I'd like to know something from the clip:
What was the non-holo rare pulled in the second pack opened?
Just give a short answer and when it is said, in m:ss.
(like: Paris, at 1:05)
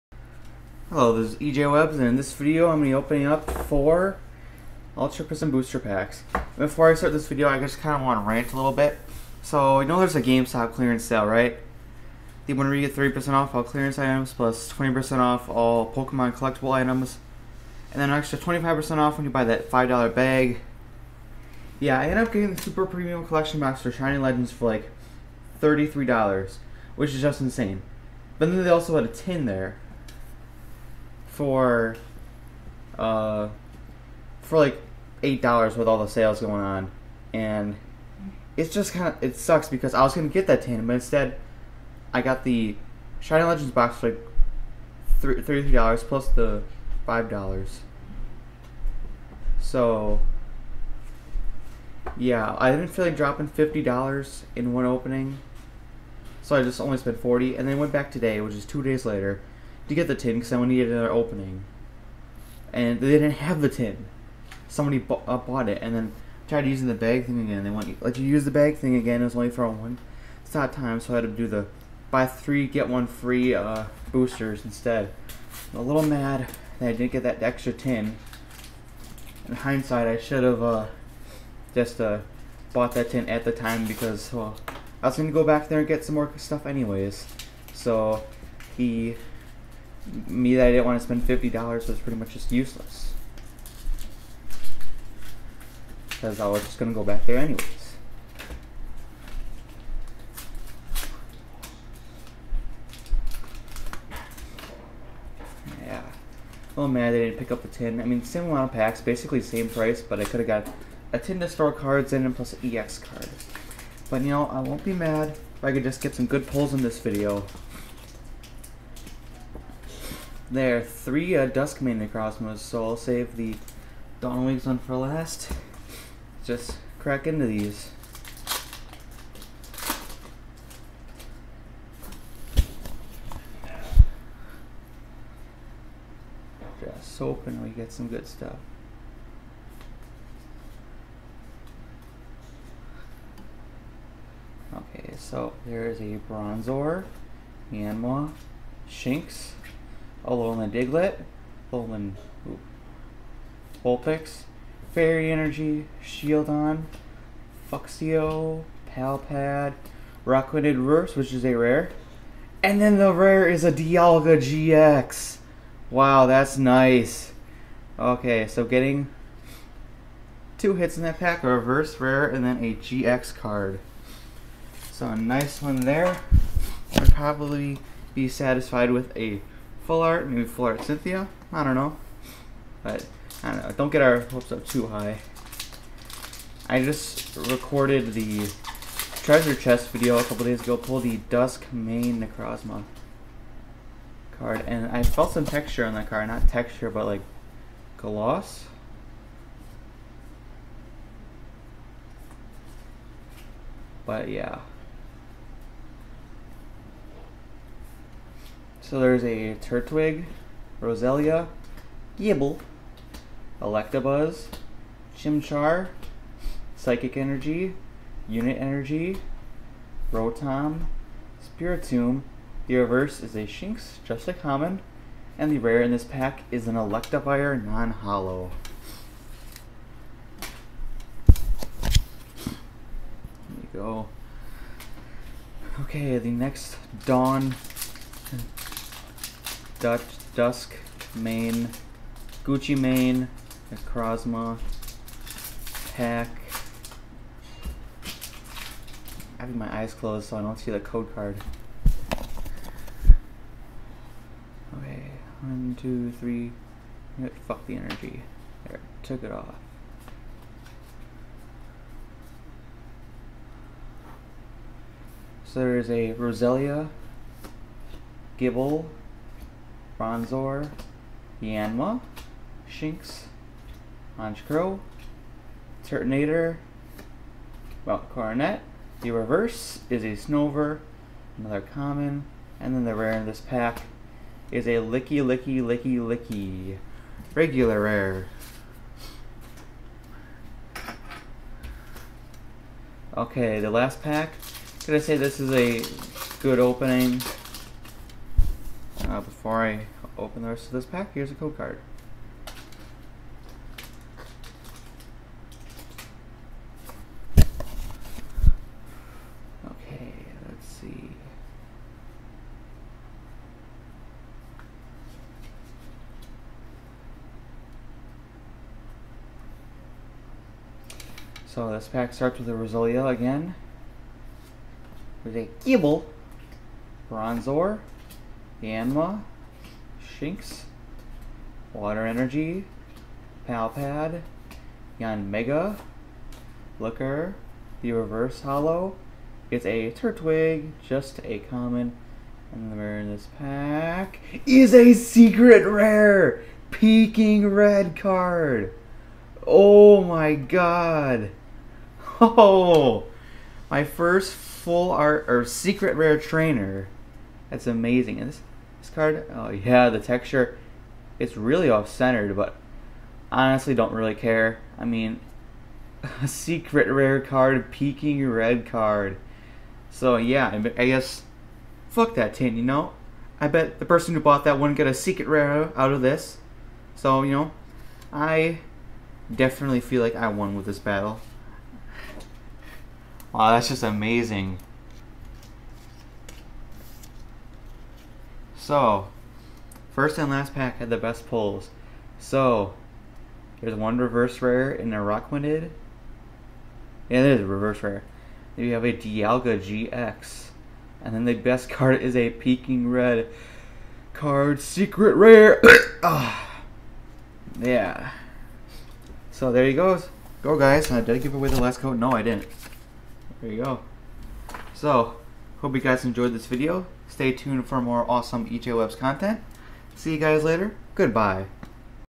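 Electivire, at 3:46.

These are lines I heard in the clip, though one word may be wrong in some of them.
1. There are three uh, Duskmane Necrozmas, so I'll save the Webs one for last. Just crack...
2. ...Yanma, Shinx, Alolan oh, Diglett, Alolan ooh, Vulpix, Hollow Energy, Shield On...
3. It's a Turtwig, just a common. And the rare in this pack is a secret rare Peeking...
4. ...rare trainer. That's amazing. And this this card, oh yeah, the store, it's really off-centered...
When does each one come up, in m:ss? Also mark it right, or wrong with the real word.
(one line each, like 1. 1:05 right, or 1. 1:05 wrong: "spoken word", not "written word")
1. 2:00 wrong: "Dawnwings", not "Webs"
2. 2:27 wrong: "Fairy", not "Hollow"
3. 5:39 right
4. 5:55 wrong: "texture", not "store".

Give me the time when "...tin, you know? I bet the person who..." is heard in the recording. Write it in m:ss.
6:12.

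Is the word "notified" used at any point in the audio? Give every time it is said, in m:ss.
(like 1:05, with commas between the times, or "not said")
not said.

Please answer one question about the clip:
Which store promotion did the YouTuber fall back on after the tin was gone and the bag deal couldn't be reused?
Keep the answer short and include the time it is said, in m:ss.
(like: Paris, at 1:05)
buy three get one free, at 1:12.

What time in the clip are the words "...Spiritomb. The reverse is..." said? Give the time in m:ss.
3:41.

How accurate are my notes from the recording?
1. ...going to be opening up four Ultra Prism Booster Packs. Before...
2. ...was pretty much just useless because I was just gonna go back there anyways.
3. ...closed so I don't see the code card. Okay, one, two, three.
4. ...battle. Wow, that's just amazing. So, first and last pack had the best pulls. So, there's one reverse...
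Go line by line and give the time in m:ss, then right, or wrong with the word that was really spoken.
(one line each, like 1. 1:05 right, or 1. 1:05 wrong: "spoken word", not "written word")
1. 0:02 right
2. 1:31 right
3. 4:09 right
4. 6:20 right.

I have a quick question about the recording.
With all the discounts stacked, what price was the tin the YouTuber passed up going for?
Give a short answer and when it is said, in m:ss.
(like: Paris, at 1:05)
$8, at 0:35.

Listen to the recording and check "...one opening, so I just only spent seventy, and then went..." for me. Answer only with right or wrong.
wrong.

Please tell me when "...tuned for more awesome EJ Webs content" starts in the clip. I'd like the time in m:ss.
6:57.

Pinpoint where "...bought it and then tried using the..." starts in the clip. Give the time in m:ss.
1:05.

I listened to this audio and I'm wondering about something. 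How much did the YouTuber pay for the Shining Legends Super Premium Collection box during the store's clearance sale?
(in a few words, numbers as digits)
$33.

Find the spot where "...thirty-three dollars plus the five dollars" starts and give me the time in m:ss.
0:45.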